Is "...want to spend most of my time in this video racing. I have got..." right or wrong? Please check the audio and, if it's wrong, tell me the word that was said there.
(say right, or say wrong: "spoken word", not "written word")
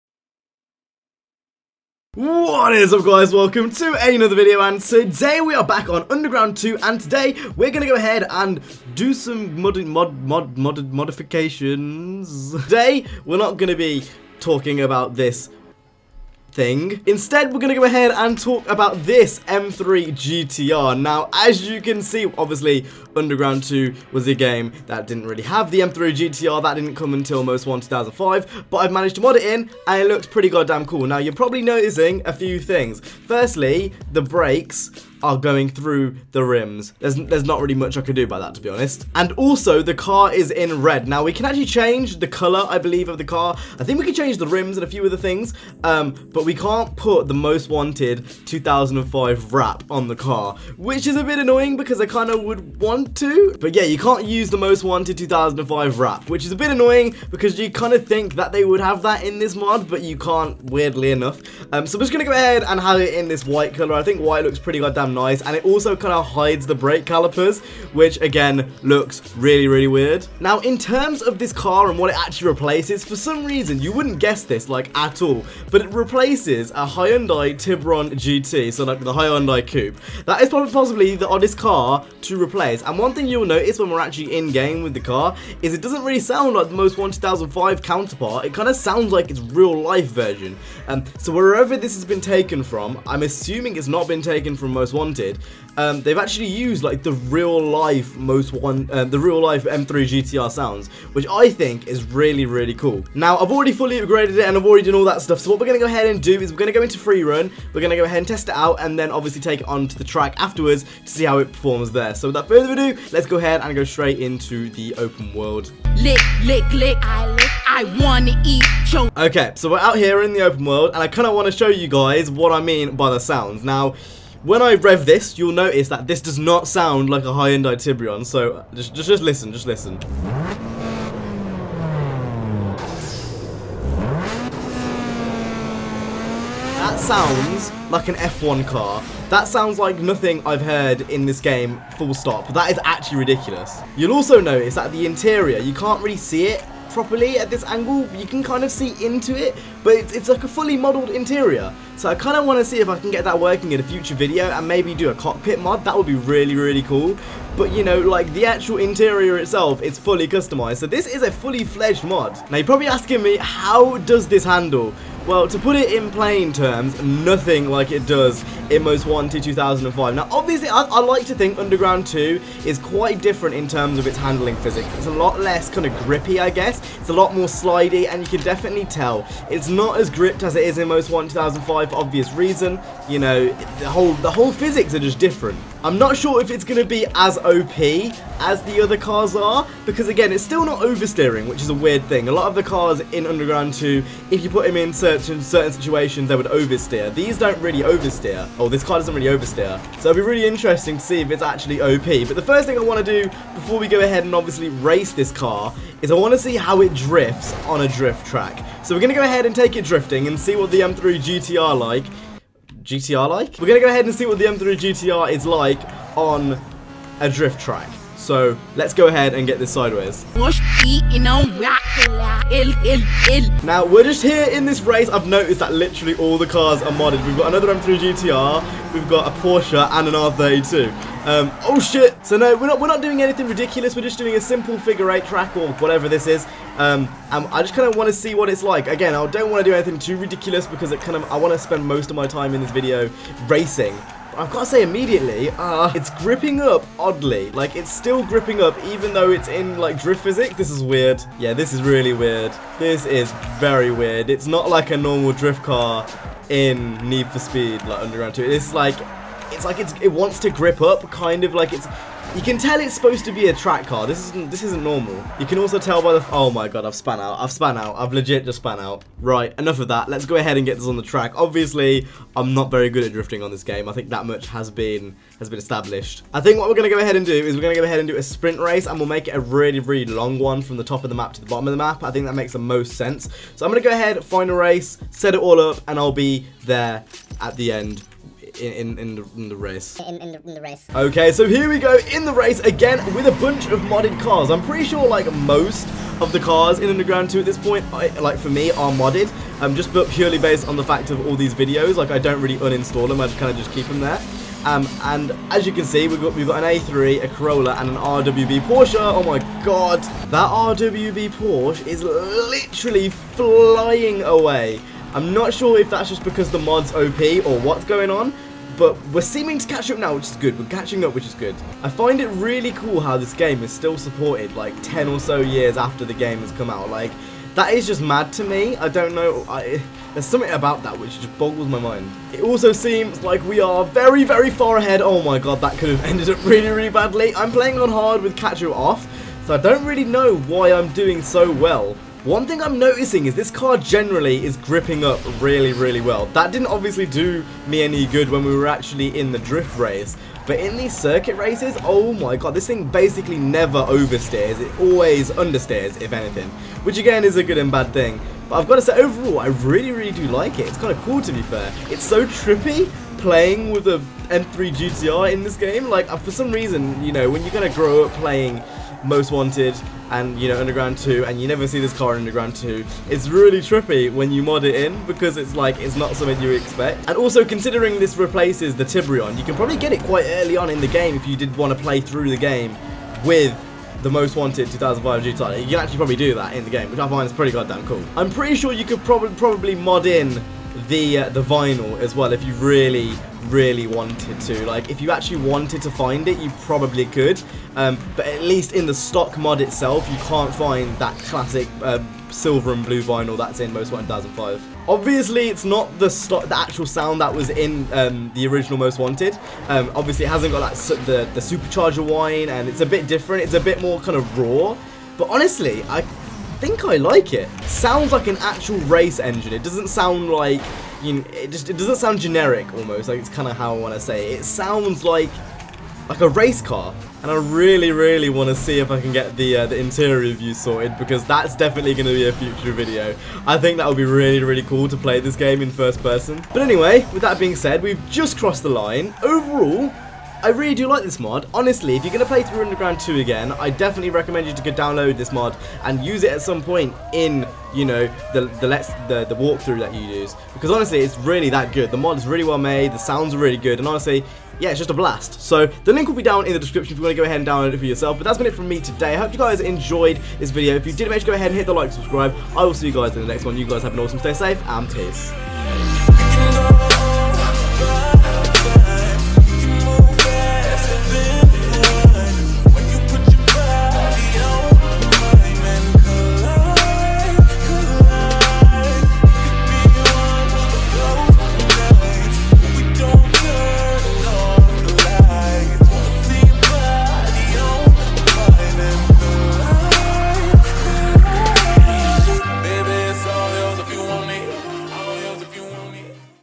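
right.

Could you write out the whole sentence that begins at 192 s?
A lot of the cars in Underground 2, if you put them in certain, certain situations, they would oversteer.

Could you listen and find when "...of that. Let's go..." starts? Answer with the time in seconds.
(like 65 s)
269 s.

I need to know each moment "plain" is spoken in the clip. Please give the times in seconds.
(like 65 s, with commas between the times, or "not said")
166 s.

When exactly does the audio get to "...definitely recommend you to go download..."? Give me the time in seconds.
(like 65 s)
443 s.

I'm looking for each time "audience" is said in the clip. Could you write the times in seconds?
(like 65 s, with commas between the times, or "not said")
not said.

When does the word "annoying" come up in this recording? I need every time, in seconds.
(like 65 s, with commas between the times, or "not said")
51 s, 56 s.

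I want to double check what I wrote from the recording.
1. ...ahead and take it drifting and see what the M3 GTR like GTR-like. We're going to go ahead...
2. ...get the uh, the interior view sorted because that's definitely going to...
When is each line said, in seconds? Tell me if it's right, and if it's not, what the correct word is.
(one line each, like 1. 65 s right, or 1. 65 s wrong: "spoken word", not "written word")
1. 209 s right
2. 429 s right.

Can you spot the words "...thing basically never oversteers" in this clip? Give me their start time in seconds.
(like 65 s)
352 s.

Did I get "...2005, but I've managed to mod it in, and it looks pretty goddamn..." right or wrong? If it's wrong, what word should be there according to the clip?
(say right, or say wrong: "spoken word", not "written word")
right.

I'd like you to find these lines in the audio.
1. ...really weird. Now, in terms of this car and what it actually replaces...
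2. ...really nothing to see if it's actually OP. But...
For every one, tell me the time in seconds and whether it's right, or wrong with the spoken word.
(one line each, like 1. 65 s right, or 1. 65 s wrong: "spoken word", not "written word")
1. 69 s right
2. 200 s wrong: "interesting", not "nothing".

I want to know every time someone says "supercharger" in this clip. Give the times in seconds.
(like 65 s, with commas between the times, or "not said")
411 s.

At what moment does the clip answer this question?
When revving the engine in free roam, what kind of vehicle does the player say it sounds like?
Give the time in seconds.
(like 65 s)
138 s.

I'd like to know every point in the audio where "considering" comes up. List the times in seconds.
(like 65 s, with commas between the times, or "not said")
377 s.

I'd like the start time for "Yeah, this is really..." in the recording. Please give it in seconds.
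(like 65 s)
251 s.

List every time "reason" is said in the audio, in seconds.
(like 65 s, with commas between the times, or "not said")
73 s, 182 s, 366 s.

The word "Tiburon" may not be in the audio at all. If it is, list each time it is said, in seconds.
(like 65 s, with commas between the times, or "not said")
77 s, 127 s, 378 s.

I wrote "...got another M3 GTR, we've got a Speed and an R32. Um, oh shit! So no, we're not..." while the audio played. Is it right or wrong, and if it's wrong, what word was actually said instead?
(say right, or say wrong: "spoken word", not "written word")
wrong: "Porsche", not "Speed".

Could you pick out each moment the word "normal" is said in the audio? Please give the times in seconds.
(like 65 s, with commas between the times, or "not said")
254 s, 264 s.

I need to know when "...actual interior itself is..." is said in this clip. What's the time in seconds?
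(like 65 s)
158 s.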